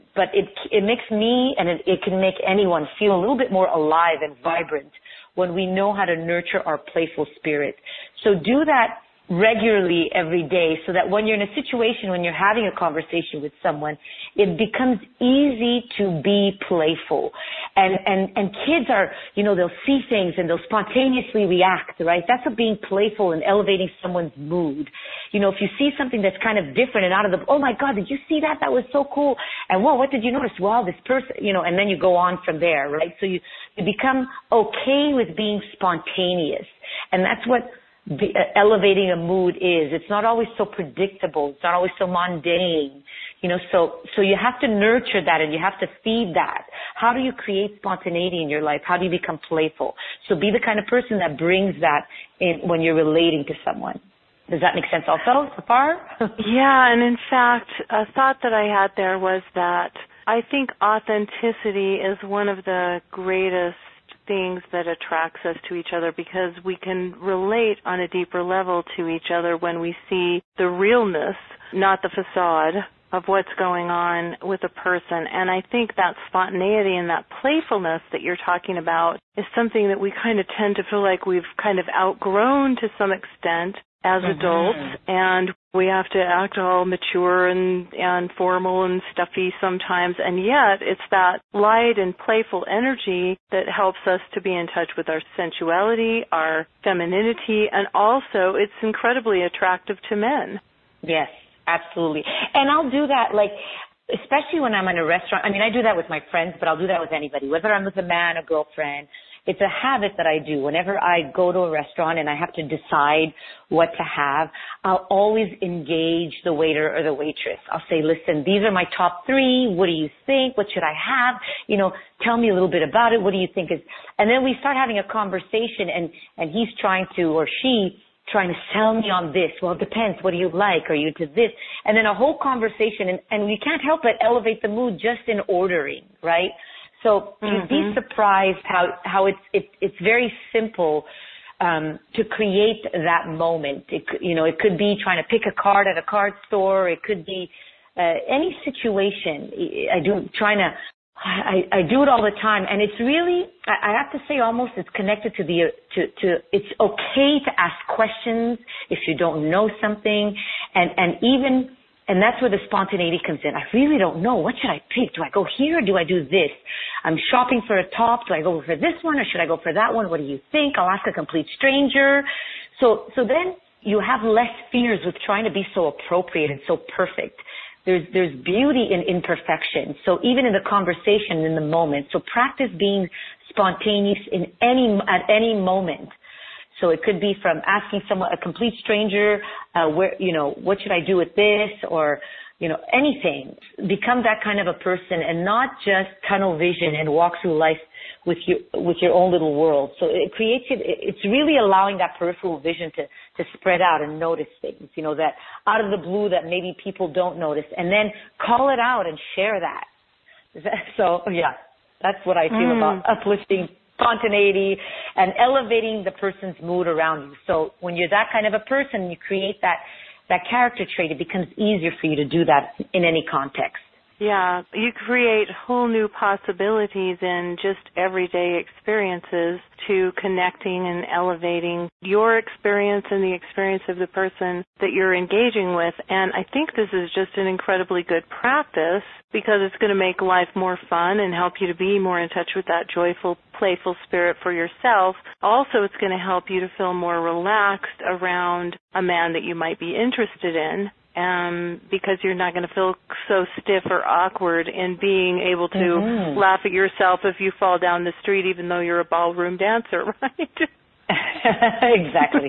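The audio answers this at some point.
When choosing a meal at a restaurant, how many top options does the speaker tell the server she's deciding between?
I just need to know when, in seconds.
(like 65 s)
119 s.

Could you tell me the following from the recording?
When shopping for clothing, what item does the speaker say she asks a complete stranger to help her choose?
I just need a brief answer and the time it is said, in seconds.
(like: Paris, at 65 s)
a top, at 167 s.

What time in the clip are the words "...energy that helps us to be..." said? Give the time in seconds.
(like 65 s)
92 s.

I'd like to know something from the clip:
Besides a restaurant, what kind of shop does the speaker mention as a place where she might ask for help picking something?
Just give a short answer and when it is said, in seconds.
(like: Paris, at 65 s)
card store, at 146 s.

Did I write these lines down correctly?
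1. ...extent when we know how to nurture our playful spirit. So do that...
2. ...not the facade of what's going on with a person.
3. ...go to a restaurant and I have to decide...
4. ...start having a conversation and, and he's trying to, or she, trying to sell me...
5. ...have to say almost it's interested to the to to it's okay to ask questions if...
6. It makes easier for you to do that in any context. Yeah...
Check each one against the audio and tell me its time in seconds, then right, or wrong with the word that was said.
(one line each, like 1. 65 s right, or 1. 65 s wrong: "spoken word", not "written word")
1. 4 s wrong: "vibrant", not "extent"
2. 71 s right
3. 111 s right
4. 124 s right
5. 154 s wrong: "connected", not "interested"
6. 221 s wrong: "becomes", not "makes".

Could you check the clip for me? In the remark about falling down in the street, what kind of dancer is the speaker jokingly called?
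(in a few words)
ballroom dancer.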